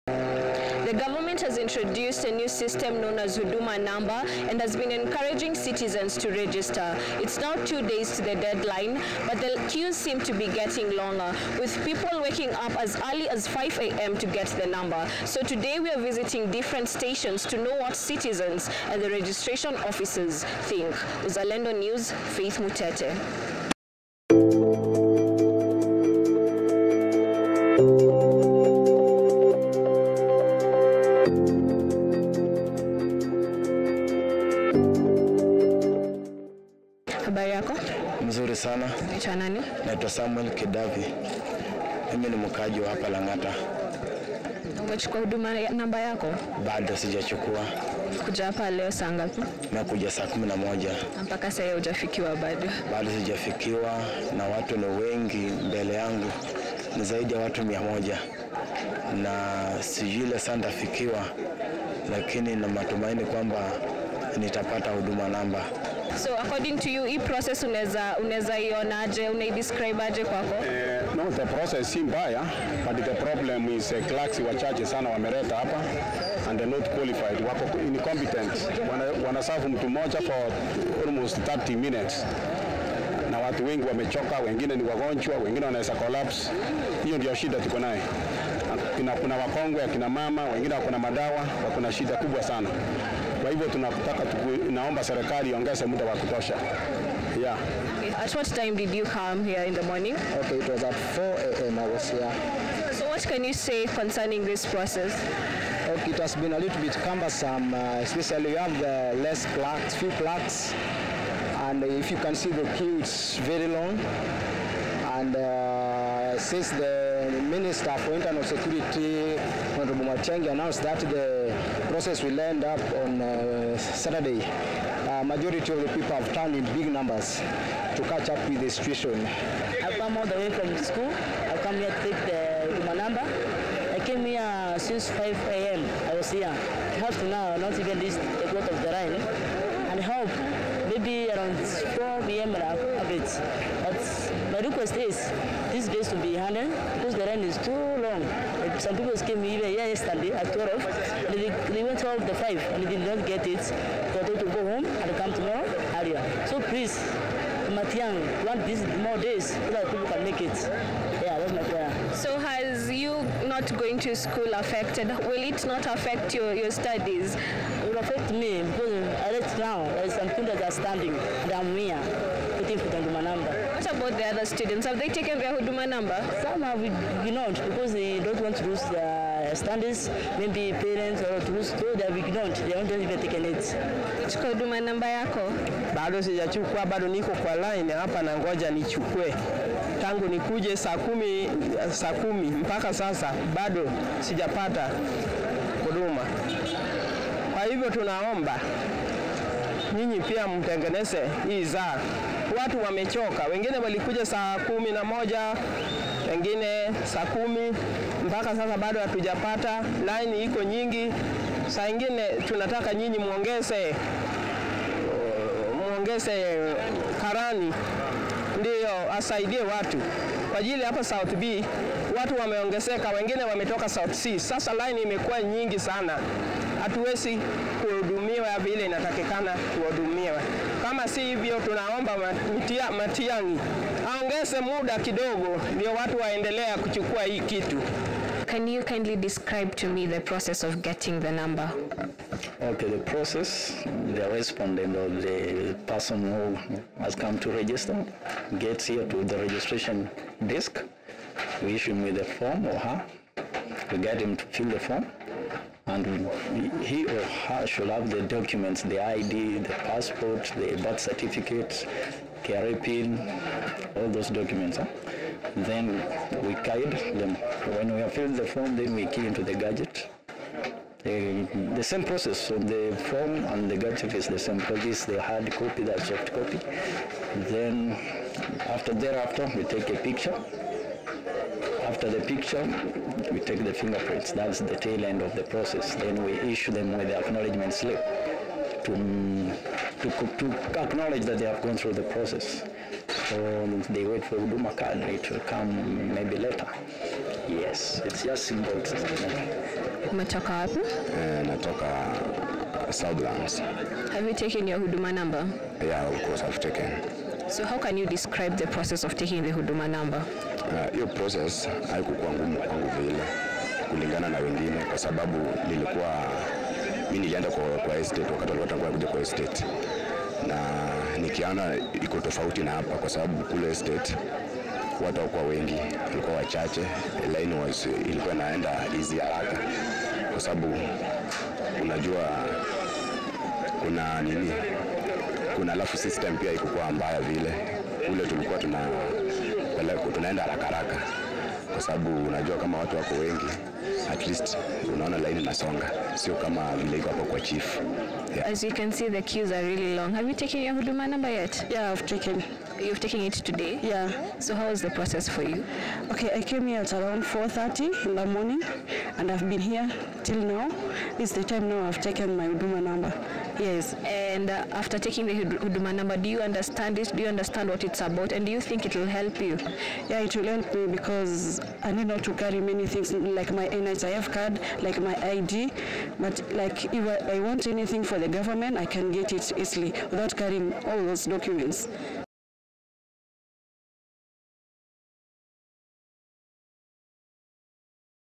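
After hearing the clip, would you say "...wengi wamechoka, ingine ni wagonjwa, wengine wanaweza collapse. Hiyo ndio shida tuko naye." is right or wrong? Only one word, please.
wrong.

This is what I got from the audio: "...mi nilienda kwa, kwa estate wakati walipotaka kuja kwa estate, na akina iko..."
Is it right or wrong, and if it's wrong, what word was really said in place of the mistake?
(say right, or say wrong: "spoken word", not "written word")
wrong: "nikiona", not "akina".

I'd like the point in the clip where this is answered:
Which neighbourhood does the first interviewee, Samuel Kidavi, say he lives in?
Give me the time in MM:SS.
00:43.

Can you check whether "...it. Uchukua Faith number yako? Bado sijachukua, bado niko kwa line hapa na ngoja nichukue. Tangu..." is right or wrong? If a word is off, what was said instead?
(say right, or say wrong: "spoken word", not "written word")
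wrong: "Huduma", not "Faith".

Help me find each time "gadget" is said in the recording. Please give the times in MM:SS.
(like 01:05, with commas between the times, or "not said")
04:29, 04:33.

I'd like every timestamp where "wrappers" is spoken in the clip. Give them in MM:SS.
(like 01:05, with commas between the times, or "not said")
not said.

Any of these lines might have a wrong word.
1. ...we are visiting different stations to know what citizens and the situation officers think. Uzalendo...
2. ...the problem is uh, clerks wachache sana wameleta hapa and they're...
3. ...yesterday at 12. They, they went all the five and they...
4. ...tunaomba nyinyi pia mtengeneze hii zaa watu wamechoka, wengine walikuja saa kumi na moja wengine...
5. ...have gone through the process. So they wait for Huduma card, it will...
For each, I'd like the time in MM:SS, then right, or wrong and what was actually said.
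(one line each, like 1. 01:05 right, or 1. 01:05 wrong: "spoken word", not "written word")
1. 00:15 wrong: "registration", not "situation"
2. 01:13 right
3. 02:29 right
4. 03:17 right
5. 04:51 right.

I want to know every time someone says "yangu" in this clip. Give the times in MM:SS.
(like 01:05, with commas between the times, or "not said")
00:55.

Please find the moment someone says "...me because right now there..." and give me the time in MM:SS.
02:48.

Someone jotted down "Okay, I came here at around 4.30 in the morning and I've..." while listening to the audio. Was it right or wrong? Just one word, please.
right.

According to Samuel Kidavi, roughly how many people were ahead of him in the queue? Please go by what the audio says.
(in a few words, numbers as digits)
over 100.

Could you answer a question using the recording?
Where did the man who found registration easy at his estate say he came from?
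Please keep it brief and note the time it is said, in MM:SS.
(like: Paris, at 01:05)
Southlands, at 05:02.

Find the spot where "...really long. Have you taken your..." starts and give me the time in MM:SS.
05:49.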